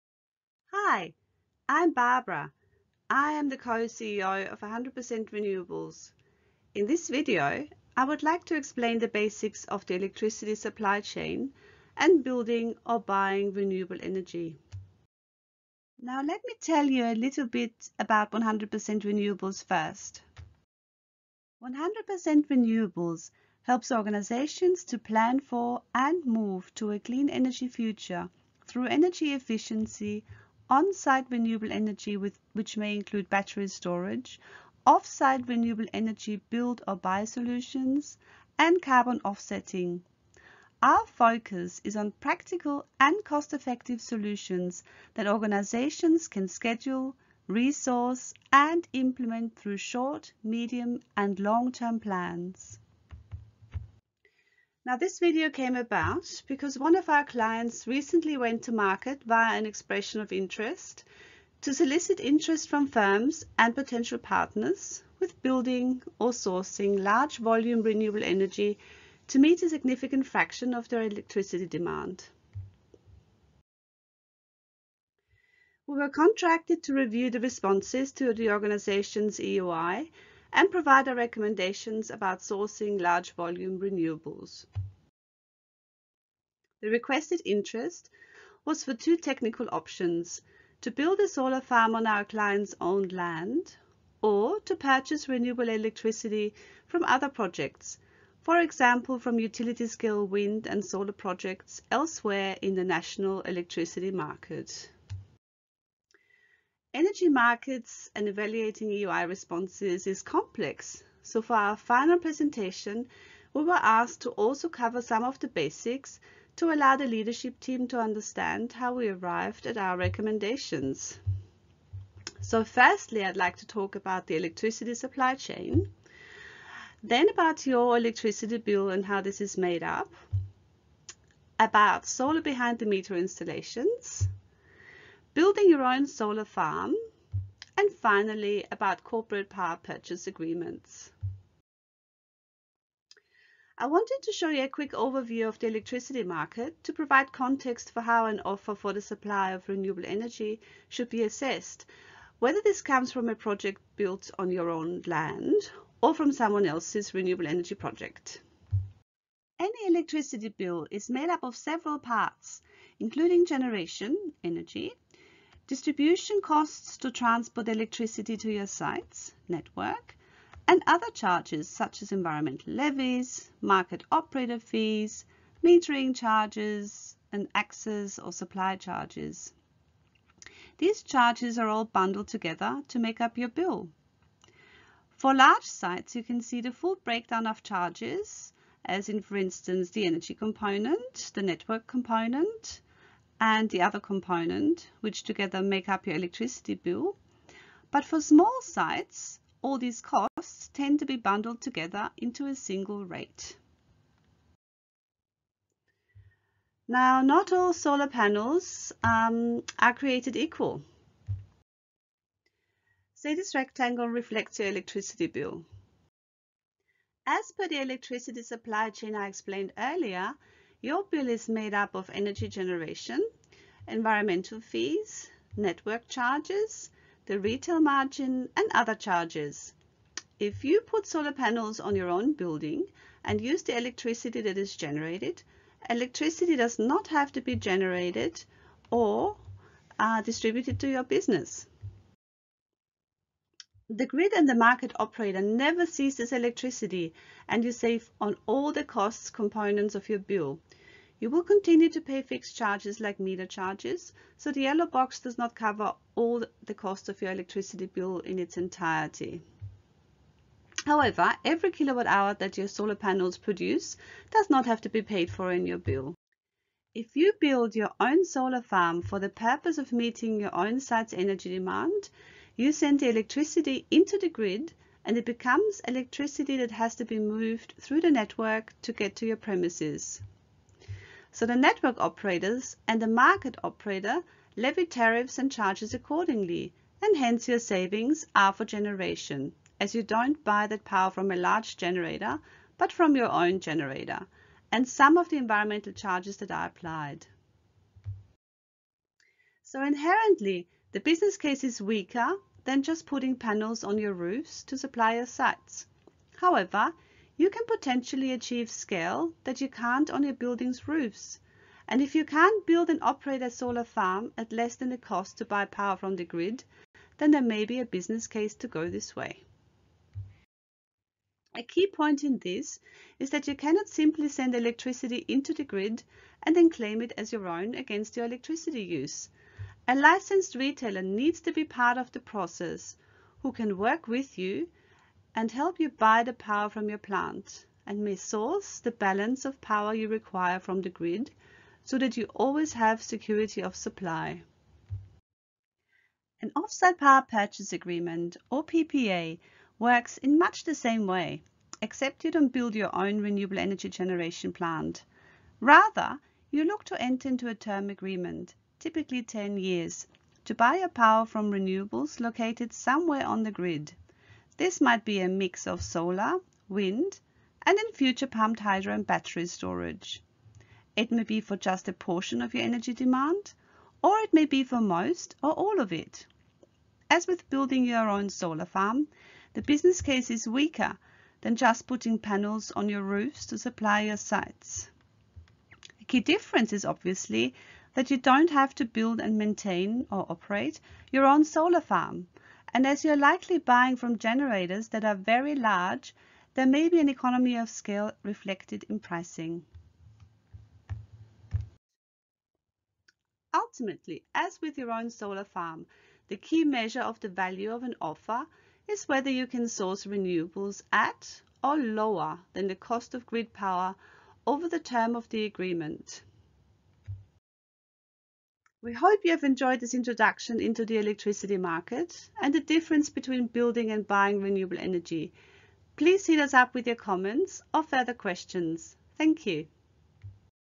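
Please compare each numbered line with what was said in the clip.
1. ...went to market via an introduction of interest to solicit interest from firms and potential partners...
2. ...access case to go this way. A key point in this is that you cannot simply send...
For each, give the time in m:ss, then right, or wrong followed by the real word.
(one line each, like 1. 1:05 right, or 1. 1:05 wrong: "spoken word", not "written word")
1. 0:58 wrong: "expression", not "introduction"
2. 5:17 wrong: "business", not "access".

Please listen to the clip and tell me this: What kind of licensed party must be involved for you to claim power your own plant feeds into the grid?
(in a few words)
A licensed retailer.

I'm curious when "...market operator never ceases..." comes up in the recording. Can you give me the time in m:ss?
4:04.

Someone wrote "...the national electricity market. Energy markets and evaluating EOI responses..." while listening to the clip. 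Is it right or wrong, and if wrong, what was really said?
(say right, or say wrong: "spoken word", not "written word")
right.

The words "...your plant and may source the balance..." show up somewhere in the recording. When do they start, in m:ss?
5:36.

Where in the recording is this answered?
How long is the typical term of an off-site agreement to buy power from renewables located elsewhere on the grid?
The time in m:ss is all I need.
5:59.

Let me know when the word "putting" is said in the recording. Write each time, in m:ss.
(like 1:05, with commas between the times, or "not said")
5:03, 6:21.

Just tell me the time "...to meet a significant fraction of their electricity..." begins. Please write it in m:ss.
1:09.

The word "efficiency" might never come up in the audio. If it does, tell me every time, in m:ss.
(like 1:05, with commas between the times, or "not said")
0:29.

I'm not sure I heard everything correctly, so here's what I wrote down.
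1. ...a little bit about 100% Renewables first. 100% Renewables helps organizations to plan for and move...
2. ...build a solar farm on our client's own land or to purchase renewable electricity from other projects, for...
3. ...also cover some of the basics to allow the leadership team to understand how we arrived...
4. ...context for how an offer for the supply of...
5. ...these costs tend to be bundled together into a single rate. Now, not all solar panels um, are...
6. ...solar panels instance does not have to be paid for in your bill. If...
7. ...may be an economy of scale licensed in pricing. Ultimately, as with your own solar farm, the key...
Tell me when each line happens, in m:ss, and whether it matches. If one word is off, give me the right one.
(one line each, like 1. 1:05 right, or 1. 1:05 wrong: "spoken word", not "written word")
1. 0:17 right
2. 1:30 right
3. 1:54 right
4. 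2:27 right
5. 3:19 right
6. 4:22 wrong: "produce", not "instance"
7. 6:36 wrong: "reflected", not "licensed".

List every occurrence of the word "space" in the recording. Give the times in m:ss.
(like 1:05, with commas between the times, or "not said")
not said.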